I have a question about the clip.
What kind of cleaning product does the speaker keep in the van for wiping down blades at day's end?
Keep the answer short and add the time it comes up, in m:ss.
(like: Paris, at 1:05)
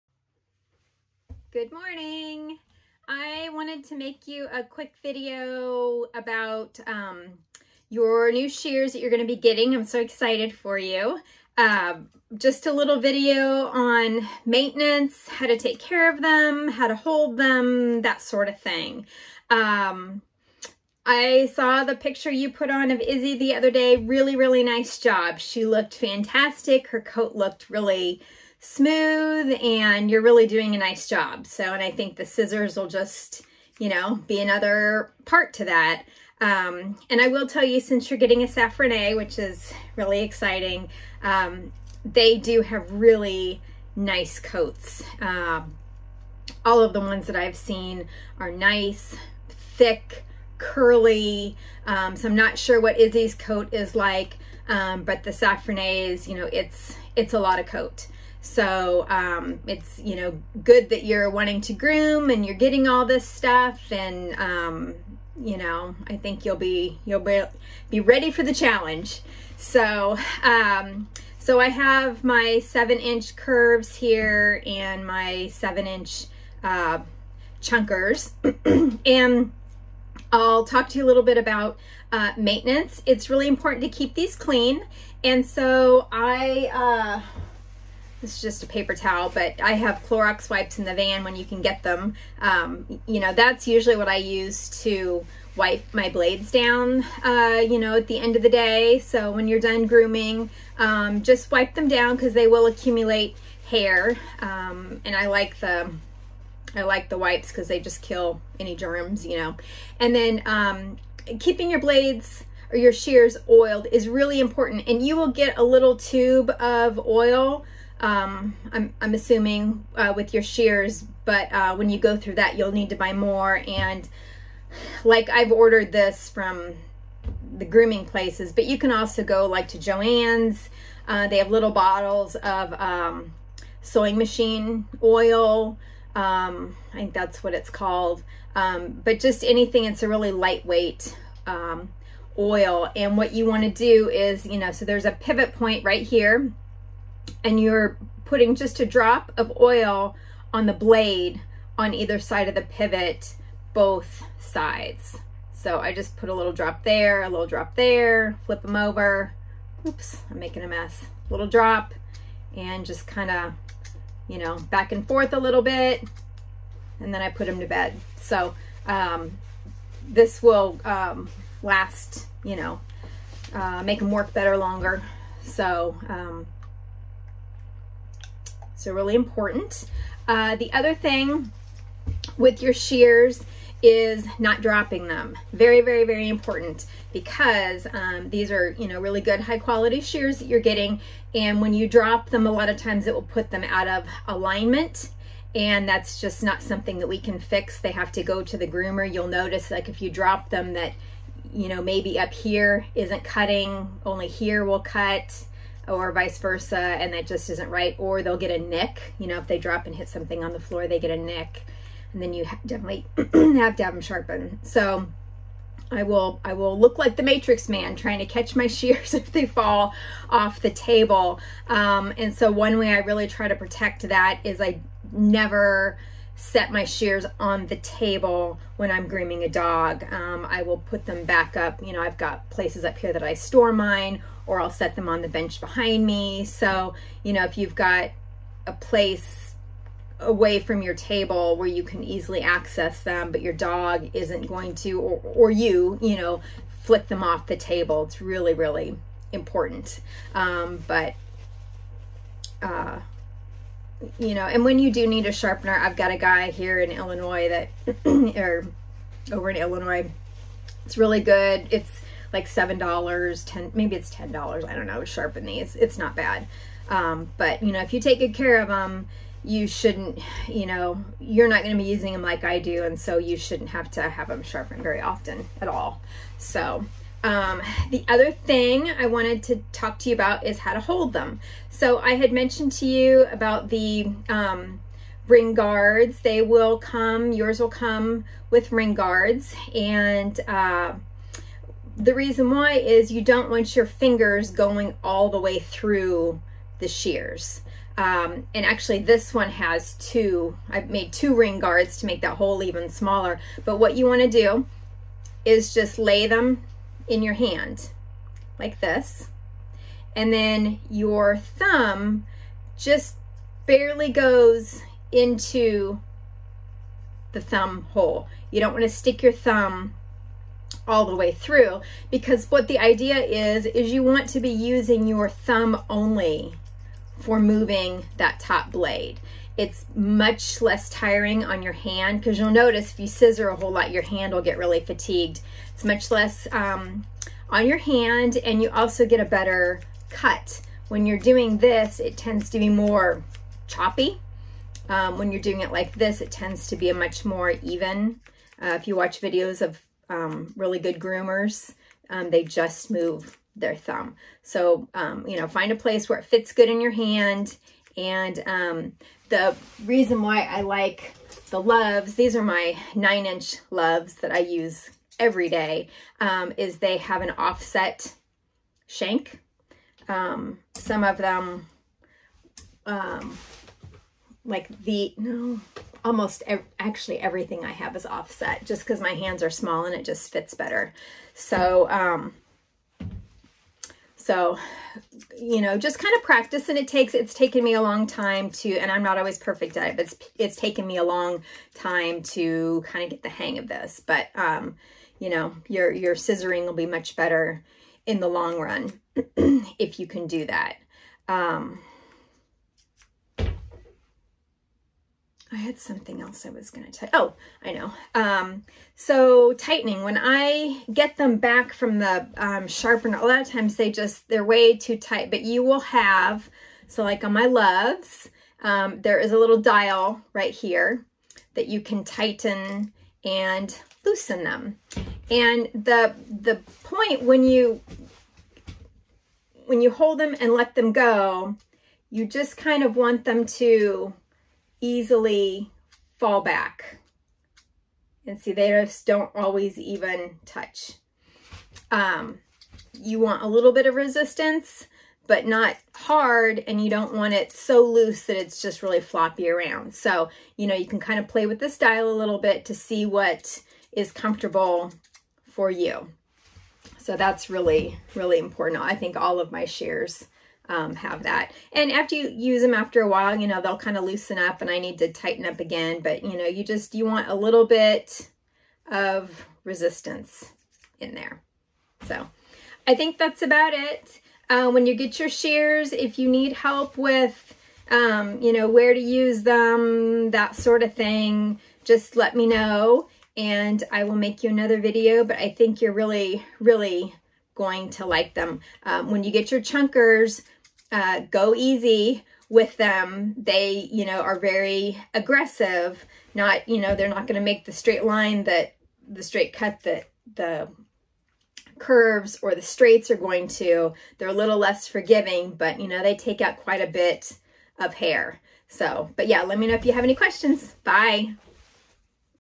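Clorox wipes, at 1:30.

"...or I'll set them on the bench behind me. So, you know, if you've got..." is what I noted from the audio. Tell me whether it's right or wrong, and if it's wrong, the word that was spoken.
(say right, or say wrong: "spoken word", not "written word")
right.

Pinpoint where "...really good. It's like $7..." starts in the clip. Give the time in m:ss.
4:20.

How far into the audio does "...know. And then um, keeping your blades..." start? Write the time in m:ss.
1:49.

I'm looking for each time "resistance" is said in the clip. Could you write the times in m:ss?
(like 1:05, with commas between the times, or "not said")
7:23, 7:49.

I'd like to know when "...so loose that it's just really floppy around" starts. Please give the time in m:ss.
7:27.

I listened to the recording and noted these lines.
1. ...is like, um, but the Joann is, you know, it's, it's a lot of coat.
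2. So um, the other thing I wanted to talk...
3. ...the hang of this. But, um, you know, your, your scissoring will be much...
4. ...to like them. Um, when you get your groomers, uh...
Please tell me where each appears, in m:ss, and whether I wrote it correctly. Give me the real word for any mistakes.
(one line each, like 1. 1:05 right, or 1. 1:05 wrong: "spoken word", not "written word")
1. 0:53 wrong: "Saffronet", not "Joann"
2. 4:36 right
3. 6:33 right
4. 8:07 wrong: "chunkers", not "groomers".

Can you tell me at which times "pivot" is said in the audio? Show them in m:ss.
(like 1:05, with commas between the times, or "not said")
2:25, 2:32.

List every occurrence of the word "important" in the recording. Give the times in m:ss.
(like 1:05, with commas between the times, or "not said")
1:23, 1:54, 2:59, 3:06, 4:09, 7:38.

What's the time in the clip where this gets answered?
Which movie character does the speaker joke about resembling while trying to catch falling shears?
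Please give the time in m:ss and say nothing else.
3:37.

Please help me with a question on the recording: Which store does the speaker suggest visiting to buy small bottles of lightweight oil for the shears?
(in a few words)
Joann's.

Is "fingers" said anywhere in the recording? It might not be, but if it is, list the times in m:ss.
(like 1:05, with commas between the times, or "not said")
4:53.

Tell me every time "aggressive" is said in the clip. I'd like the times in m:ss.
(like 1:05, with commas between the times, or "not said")
8:15.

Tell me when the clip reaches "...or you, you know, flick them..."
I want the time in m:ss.
4:05.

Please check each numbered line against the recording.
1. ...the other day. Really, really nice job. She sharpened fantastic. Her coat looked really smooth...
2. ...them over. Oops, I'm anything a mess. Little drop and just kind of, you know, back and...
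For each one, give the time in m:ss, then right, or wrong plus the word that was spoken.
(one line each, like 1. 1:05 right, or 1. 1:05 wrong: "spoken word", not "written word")
1. 0:23 wrong: "looked", not "sharpened"
2. 2:38 wrong: "making", not "anything".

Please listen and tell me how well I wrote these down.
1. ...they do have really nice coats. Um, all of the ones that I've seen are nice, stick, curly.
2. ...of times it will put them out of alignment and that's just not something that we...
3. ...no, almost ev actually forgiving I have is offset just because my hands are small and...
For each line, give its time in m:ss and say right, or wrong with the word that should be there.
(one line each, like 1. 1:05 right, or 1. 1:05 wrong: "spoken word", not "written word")
1. 0:42 wrong: "thick", not "stick"
2. 3:12 right
3. 6:15 wrong: "everything", not "forgiving".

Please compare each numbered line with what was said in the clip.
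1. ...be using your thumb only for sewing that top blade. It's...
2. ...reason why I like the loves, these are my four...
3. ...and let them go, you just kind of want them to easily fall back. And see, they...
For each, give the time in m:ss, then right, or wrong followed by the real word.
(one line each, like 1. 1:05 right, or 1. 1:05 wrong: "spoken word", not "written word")
1. 5:24 wrong: "moving", not "sewing"
2. 5:59 wrong: "nine", not "four"
3. 7:10 right.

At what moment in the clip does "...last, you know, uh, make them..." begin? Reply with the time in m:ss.
2:51.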